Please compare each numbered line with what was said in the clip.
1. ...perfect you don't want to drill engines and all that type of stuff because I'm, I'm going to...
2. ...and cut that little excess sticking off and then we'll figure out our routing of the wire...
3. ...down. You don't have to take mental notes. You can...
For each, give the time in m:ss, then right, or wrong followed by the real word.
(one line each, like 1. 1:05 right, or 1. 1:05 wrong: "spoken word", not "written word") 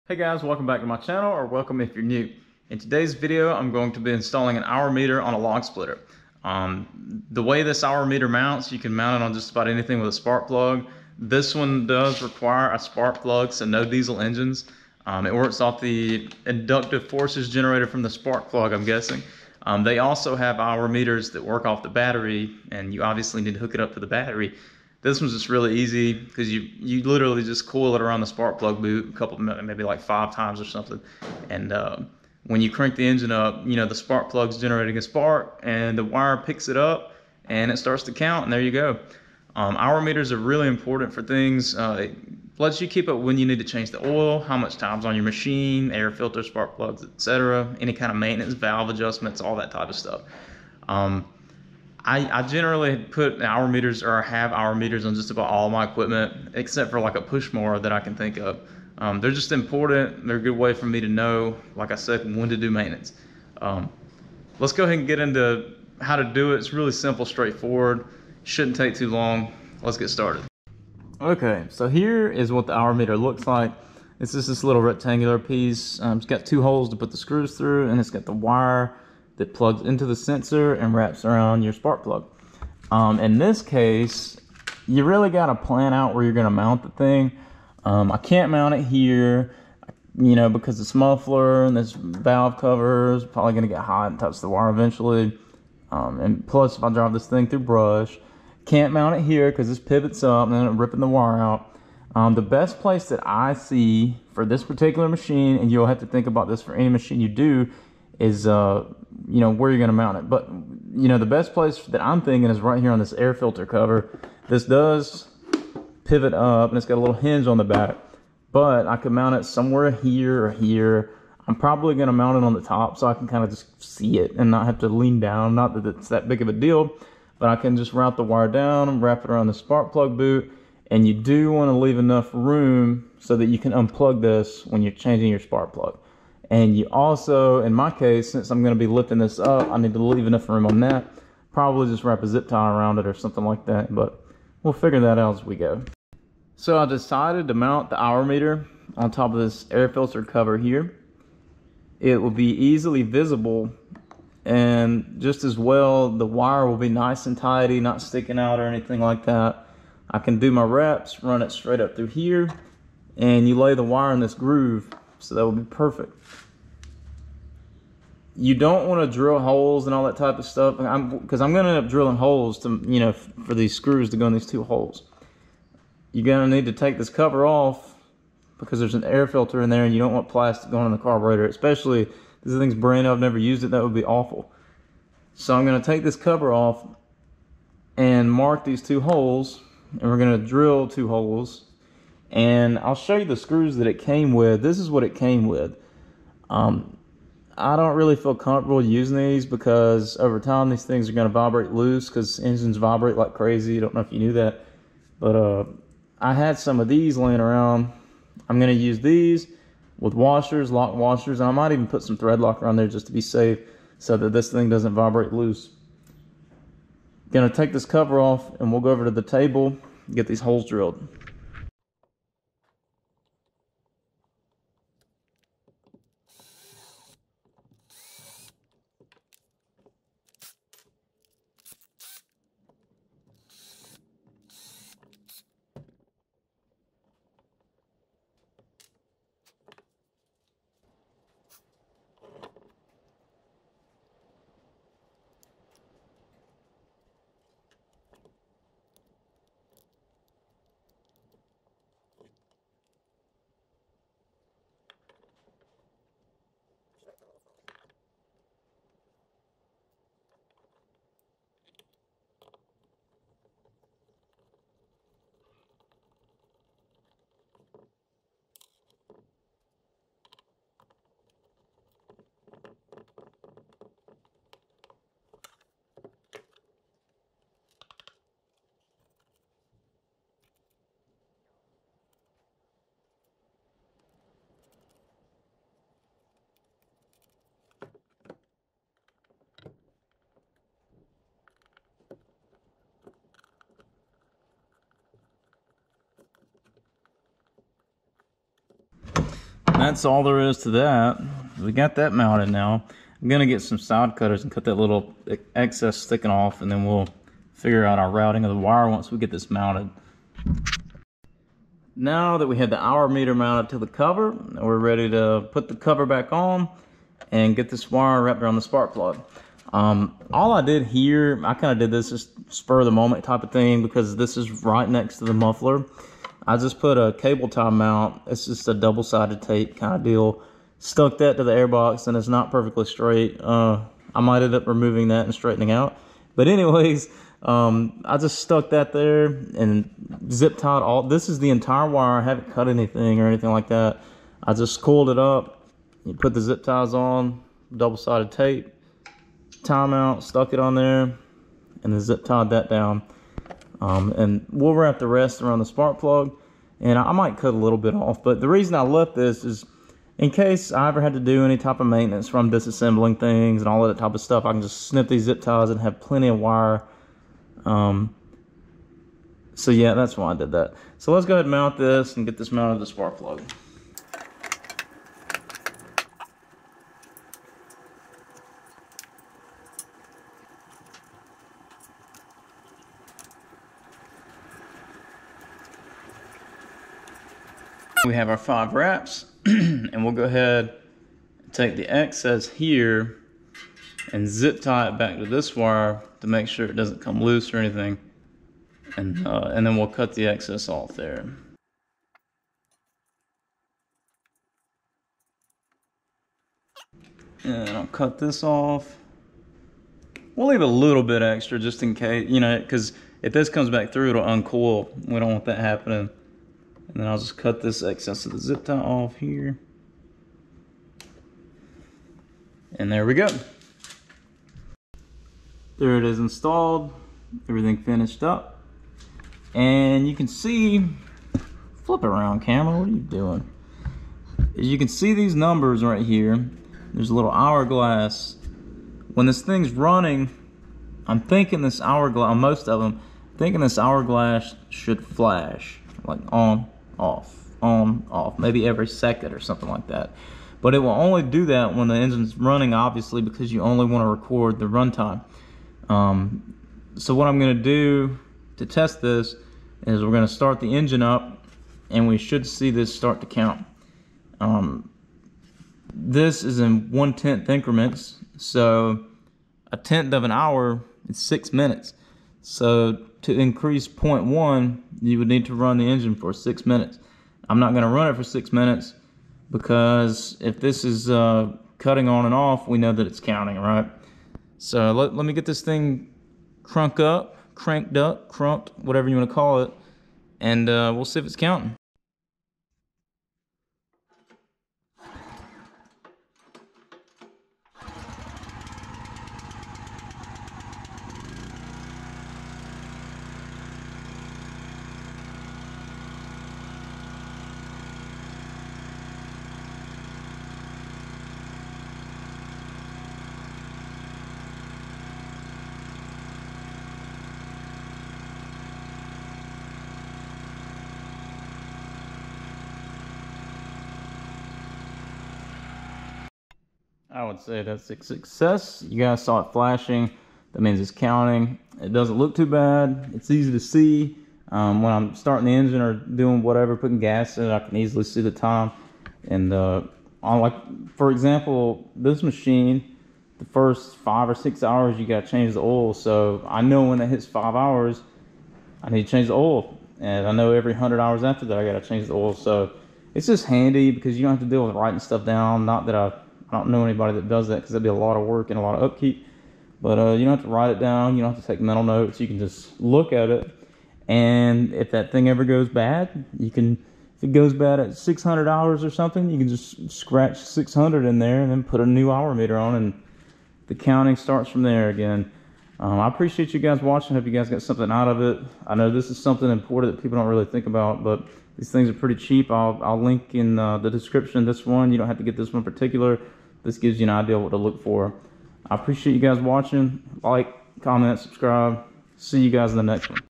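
1. 2:45 wrong: "holes", not "engines"
2. 5:04 right
3. 9:20 right.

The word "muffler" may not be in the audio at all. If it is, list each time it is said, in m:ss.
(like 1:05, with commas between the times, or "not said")
1:30, 5:25.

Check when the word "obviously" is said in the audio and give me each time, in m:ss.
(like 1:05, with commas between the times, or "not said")
0:23, 7:32.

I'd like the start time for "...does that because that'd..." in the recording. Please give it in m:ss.
9:17.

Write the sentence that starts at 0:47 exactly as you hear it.
Any kind of maintenance, valve adjustments, all that type of stuff.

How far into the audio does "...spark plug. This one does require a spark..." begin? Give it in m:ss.
0:10.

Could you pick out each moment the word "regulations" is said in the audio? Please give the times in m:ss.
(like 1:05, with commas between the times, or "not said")
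not said.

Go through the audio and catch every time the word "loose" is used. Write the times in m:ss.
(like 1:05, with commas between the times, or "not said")
3:21, 3:35, 6:37.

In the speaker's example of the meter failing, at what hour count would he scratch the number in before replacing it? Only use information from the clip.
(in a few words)
600.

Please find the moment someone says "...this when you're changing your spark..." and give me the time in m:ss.
2:14.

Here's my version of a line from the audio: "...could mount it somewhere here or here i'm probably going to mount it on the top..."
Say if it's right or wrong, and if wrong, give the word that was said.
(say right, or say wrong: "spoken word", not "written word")
right.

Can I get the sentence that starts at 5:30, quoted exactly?
Stuck that to the airbox, and it's not perfectly straight.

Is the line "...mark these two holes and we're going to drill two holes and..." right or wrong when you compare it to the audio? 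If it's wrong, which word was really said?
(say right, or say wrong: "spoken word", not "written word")
right.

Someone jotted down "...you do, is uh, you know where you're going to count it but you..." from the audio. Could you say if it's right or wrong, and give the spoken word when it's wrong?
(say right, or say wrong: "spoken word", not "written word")
wrong: "mount", not "count".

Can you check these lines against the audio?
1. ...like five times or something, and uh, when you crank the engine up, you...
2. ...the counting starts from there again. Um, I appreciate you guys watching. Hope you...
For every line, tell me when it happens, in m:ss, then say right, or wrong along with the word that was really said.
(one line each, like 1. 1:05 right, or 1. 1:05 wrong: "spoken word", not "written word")
1. 0:29 right
2. 9:33 right.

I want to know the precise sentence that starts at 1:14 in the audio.
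It's just this little rectangular piece.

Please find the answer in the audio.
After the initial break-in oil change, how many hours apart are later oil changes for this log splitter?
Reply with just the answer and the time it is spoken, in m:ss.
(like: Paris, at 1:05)
100, at 9:10.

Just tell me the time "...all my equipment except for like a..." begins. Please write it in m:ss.
0:55.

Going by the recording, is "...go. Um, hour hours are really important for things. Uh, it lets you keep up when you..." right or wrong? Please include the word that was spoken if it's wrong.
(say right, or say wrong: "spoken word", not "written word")
wrong: "meters", not "hours".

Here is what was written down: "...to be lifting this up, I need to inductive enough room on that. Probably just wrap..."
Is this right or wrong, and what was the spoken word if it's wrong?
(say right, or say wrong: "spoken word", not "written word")
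wrong: "leave", not "inductive".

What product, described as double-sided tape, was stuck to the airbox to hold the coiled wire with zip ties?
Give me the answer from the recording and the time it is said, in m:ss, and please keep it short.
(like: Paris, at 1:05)
Cable tie mount, at 5:27.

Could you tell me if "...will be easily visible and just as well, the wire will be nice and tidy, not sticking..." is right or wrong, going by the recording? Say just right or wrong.
right.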